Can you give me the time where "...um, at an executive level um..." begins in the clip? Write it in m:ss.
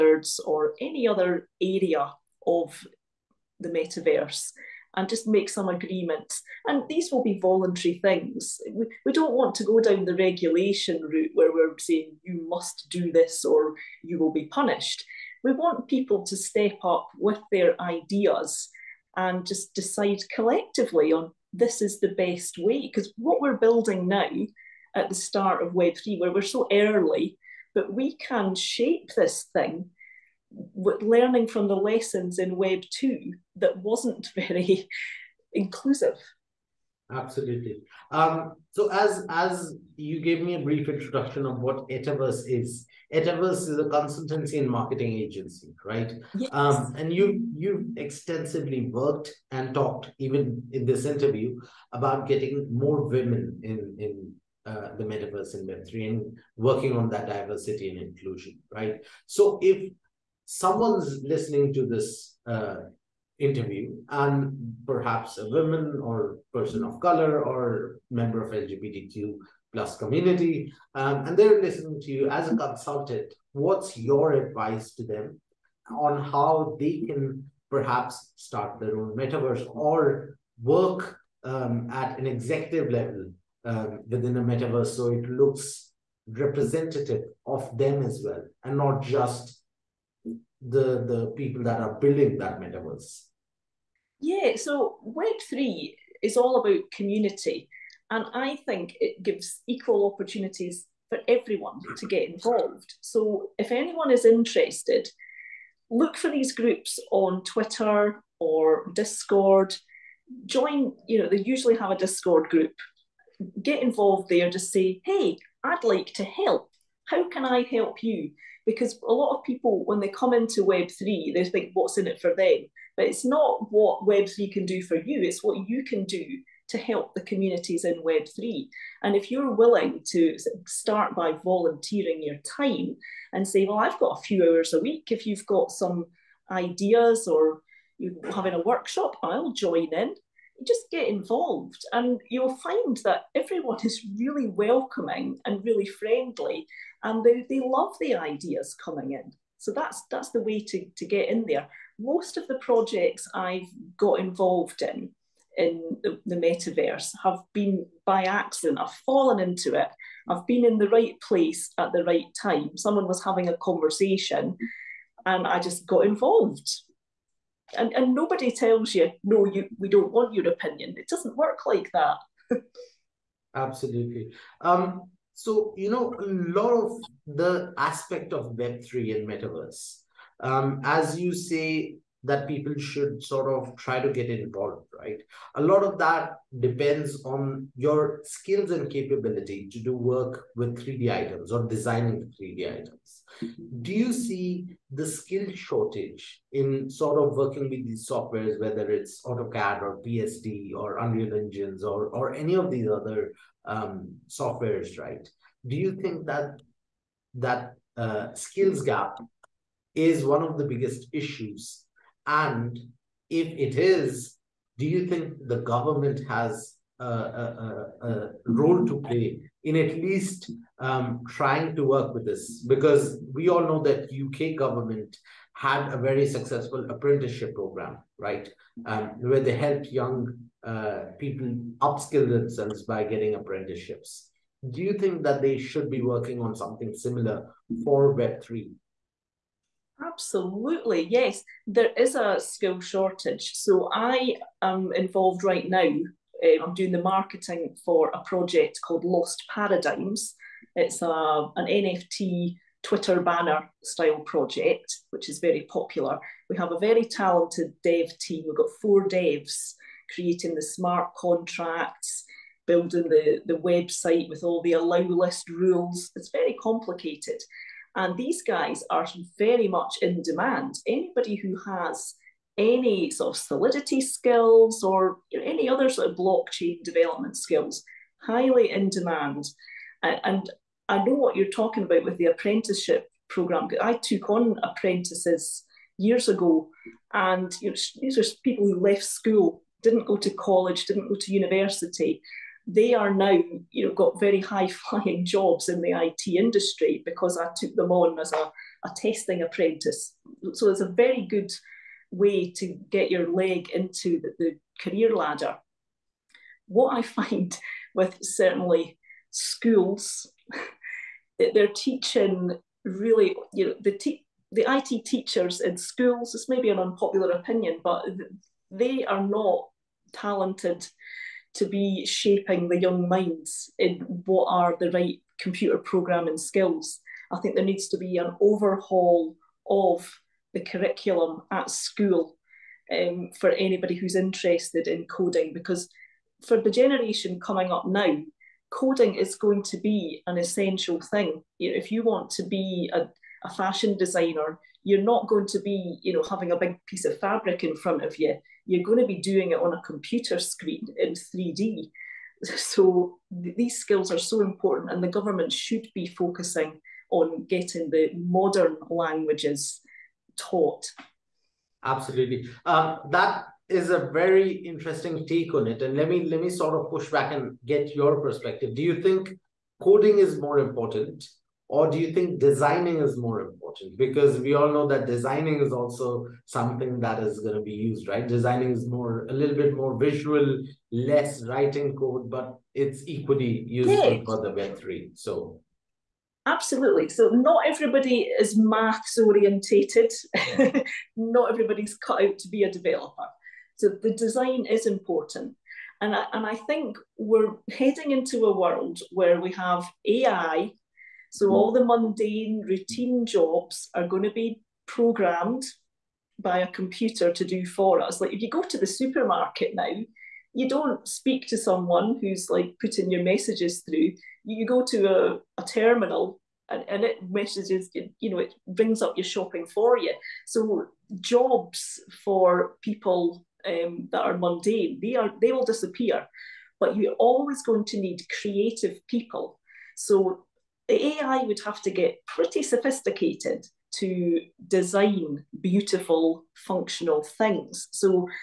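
1:21.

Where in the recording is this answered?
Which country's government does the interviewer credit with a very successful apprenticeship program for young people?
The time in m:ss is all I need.
3:44.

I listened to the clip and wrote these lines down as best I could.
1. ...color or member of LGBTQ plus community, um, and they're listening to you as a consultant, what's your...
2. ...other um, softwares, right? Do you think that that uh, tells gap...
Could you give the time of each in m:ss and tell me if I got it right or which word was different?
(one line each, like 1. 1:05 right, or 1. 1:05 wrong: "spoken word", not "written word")
1. 1:06 right
2. 3:22 wrong: "skills", not "tells".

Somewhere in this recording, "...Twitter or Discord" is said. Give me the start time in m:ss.
1:47.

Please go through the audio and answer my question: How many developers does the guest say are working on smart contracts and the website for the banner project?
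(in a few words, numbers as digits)
4.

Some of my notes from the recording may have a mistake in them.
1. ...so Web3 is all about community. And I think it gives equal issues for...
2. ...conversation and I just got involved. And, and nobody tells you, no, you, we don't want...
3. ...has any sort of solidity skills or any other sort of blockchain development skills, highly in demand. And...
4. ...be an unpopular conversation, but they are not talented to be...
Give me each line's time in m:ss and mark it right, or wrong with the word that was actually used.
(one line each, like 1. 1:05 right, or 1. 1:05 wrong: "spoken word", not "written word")
1. 1:34 wrong: "opportunities", not "issues"
2. 2:43 right
3. 4:31 right
4. 5:16 wrong: "opinion", not "conversation".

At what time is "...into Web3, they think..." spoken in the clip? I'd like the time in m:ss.
2:00.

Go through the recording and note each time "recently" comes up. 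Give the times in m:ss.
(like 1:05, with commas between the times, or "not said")
not said.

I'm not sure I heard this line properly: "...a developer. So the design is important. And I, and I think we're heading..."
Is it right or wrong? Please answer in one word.
right.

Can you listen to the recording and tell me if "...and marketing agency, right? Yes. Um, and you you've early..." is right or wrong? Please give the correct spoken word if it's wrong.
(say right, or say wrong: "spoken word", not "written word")
wrong: "extensively", not "early".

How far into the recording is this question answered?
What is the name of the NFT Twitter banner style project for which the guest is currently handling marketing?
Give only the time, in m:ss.
4:09.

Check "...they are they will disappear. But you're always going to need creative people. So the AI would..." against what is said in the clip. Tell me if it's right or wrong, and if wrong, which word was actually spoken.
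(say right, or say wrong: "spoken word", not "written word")
right.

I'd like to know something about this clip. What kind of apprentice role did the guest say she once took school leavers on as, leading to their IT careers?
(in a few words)
testing apprentice.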